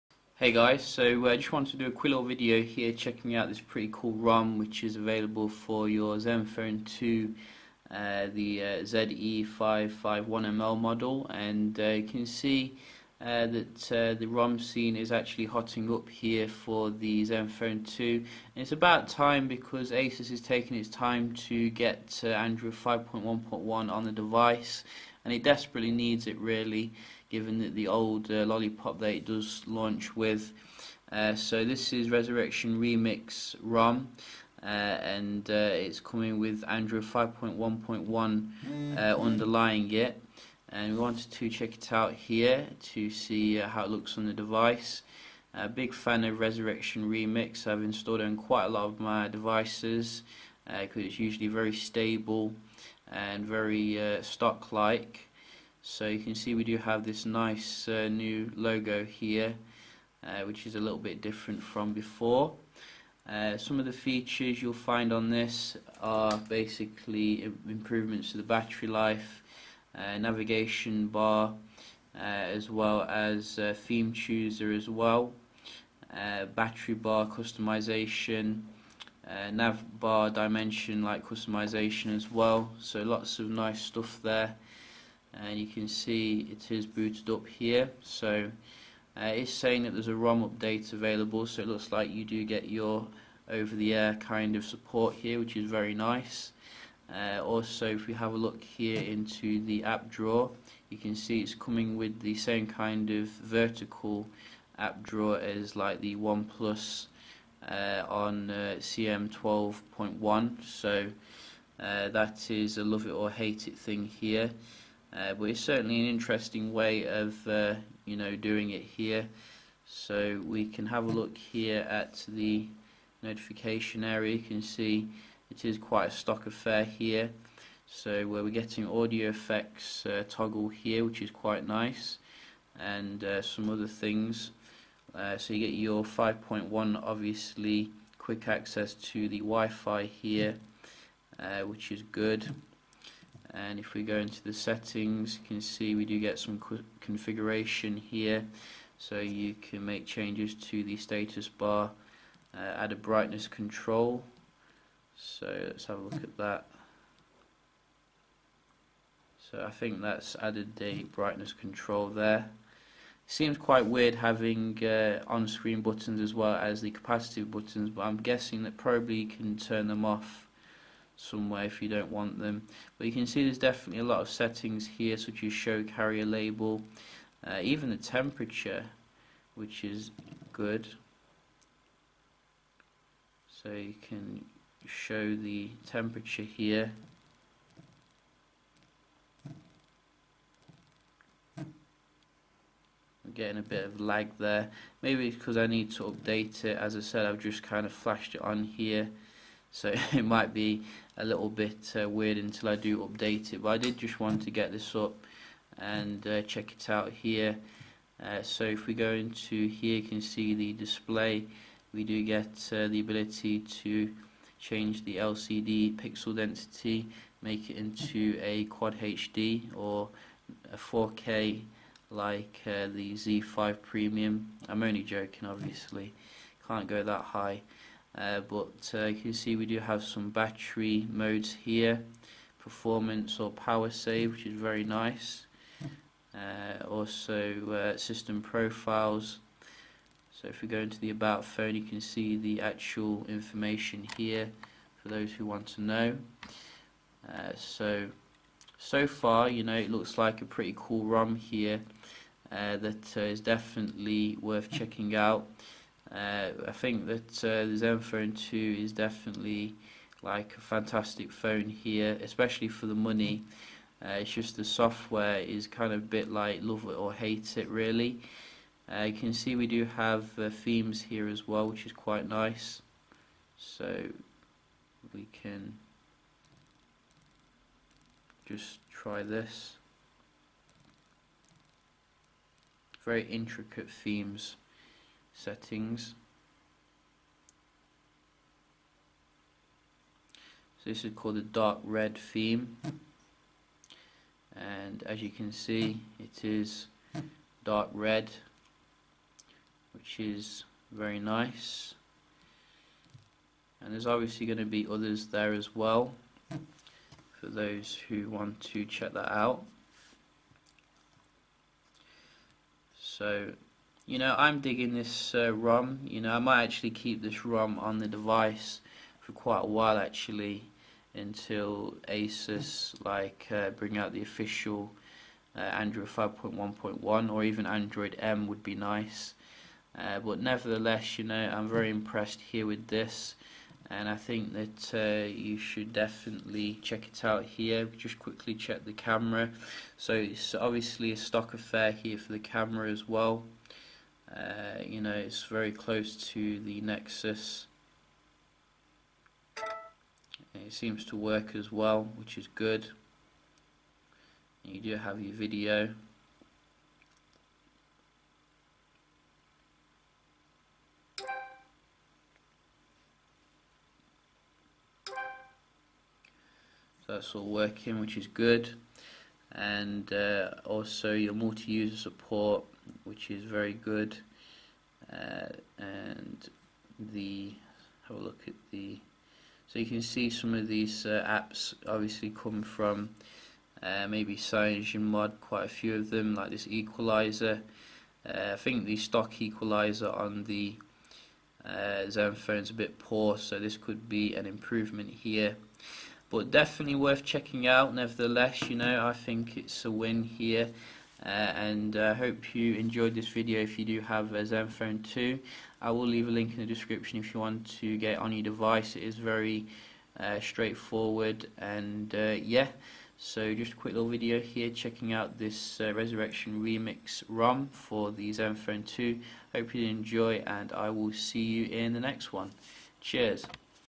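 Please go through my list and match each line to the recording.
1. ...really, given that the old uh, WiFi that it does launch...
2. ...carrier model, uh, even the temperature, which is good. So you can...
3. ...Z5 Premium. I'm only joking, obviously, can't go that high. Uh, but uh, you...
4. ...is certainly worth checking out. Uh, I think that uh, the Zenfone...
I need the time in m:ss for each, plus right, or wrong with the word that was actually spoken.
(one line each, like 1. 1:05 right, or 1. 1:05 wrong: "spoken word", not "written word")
1. 0:26 wrong: "Lollipop", not "WiFi"
2. 2:55 wrong: "label", not "model"
3. 3:43 right
4. 4:13 wrong: "definitely", not "certainly".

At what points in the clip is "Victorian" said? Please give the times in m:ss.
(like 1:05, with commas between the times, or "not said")
not said.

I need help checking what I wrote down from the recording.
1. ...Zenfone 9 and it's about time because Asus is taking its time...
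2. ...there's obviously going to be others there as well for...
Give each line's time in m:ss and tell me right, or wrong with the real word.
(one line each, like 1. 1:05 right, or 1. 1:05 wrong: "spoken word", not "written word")
1. 0:17 wrong: "2", not "9"
2. 5:03 right.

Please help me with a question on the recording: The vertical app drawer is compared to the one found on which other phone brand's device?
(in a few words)
OnePlus.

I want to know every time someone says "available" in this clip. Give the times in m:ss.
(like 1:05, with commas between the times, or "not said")
0:04, 1:30.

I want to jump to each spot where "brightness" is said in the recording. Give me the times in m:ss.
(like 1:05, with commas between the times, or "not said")
2:32, 2:41.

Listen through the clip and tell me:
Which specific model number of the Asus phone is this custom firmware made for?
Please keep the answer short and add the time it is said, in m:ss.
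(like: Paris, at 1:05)
ZE551ML, at 0:08.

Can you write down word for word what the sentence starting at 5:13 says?
So, you know, I'm digging this uh, ROM.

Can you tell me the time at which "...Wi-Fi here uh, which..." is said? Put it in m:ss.
2:19.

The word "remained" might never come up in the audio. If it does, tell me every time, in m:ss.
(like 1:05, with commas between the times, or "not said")
not said.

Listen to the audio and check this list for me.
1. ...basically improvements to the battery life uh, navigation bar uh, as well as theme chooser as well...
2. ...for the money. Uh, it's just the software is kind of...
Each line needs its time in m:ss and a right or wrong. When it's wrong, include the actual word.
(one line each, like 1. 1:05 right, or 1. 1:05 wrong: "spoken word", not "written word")
1. 1:06 right
2. 4:22 right.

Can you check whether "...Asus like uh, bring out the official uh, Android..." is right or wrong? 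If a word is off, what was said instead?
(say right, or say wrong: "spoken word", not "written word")
right.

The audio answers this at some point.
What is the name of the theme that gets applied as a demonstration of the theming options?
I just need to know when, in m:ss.
4:51.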